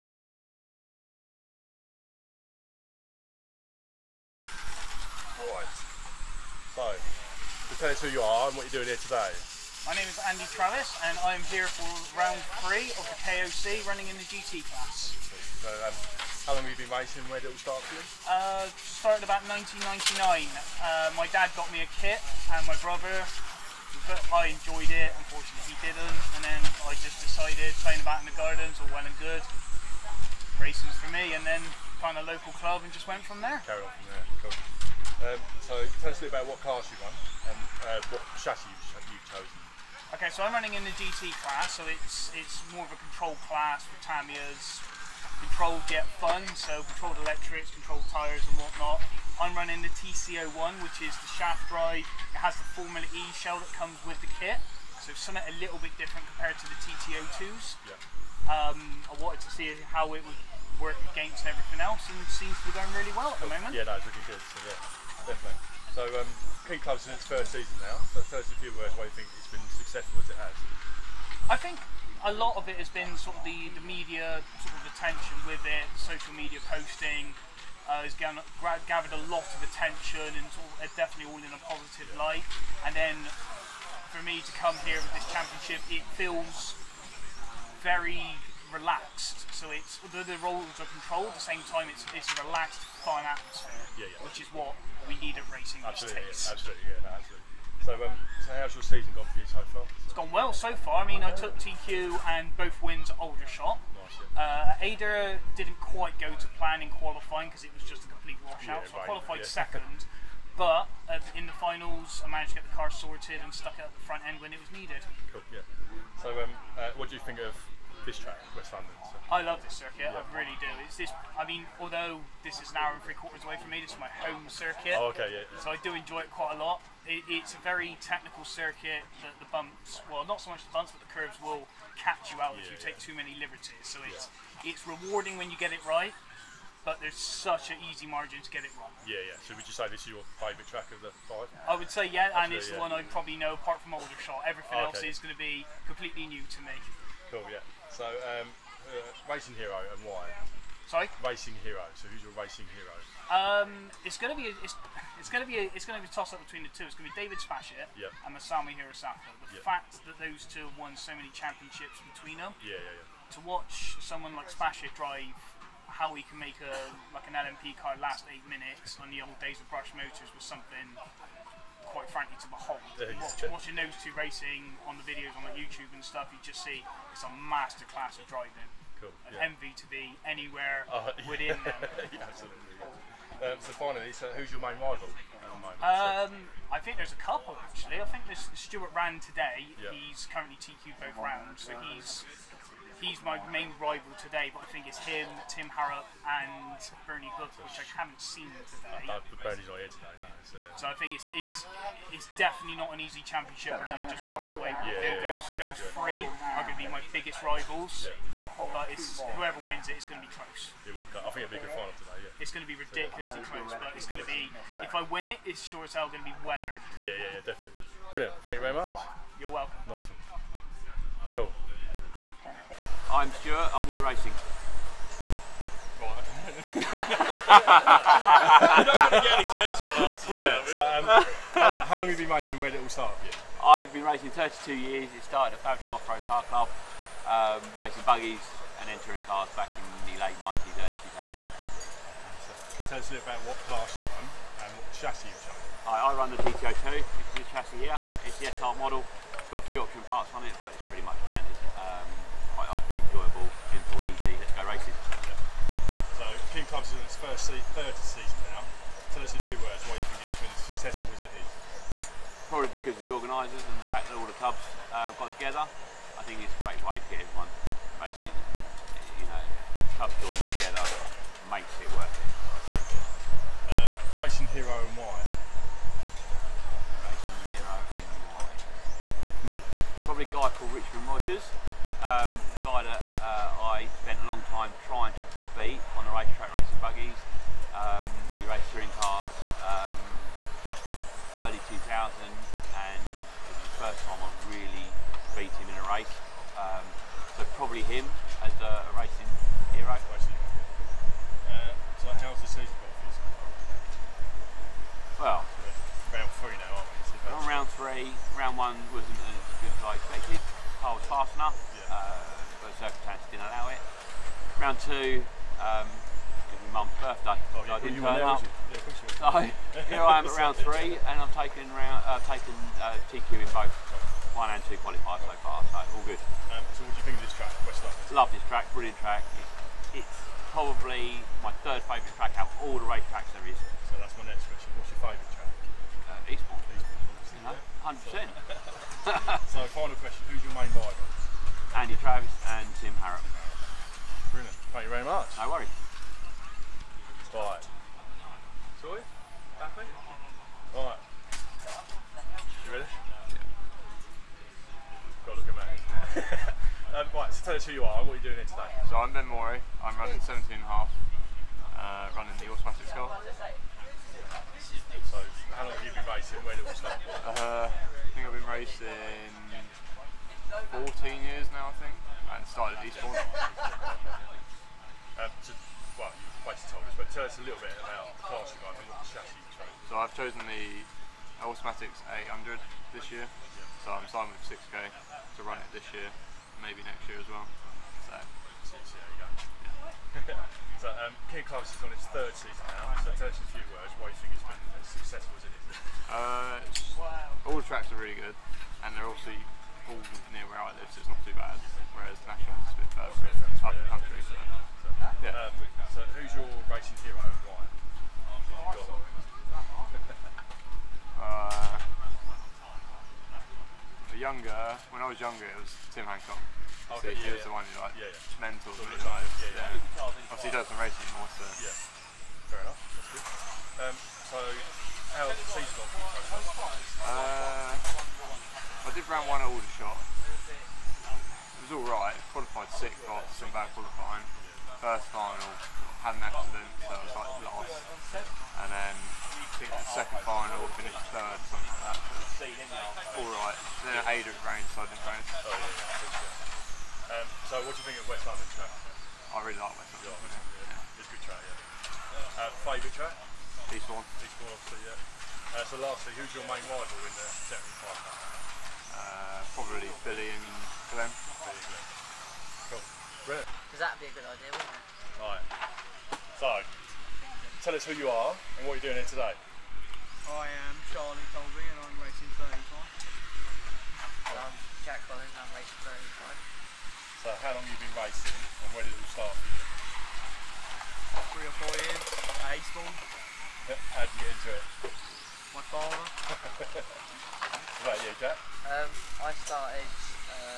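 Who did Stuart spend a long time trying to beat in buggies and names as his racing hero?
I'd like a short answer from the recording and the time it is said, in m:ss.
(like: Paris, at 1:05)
Richmond Rogers, at 4:40.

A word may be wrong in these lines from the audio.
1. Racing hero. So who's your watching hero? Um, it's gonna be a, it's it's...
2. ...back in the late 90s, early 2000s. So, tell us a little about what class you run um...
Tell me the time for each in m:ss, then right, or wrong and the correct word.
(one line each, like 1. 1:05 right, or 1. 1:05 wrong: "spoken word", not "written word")
1. 2:31 wrong: "racing", not "watching"
2. 3:59 right.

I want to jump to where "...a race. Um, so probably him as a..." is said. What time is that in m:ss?
4:55.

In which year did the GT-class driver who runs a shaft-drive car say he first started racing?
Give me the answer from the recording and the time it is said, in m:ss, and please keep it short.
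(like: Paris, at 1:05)
1999, at 0:19.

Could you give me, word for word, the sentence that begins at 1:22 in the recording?
And then for me to come here with this championship, it feels very relaxed.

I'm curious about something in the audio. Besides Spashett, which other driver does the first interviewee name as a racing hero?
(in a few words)
Masami Hirosaka.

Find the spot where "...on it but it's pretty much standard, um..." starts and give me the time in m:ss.
4:10.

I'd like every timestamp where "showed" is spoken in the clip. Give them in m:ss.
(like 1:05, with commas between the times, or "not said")
not said.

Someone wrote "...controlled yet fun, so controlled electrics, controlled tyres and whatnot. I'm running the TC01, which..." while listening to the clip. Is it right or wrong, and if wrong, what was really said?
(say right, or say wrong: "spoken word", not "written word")
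right.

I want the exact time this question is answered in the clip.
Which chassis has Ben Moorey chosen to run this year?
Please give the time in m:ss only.
6:21.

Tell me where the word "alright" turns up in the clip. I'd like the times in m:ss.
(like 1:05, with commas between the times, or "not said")
5:49, 7:11, 7:23.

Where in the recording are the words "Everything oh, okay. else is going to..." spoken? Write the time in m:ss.
2:24.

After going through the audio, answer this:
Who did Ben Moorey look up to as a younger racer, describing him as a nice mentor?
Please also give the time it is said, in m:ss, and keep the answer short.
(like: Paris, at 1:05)
Tim Hancock, at 6:55.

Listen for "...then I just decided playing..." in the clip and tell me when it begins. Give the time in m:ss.
0:26.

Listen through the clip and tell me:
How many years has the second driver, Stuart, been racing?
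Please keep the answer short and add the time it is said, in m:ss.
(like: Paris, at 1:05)
32, at 3:54.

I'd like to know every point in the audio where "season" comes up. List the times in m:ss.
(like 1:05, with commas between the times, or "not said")
1:07, 1:38, 4:18, 5:02, 6:32, 7:05.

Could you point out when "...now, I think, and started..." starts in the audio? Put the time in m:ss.
6:11.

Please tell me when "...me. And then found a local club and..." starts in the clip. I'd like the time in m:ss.
0:31.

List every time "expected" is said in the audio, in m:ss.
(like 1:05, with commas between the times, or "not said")
5:09.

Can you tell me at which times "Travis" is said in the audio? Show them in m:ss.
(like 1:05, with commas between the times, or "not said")
0:10, 5:42.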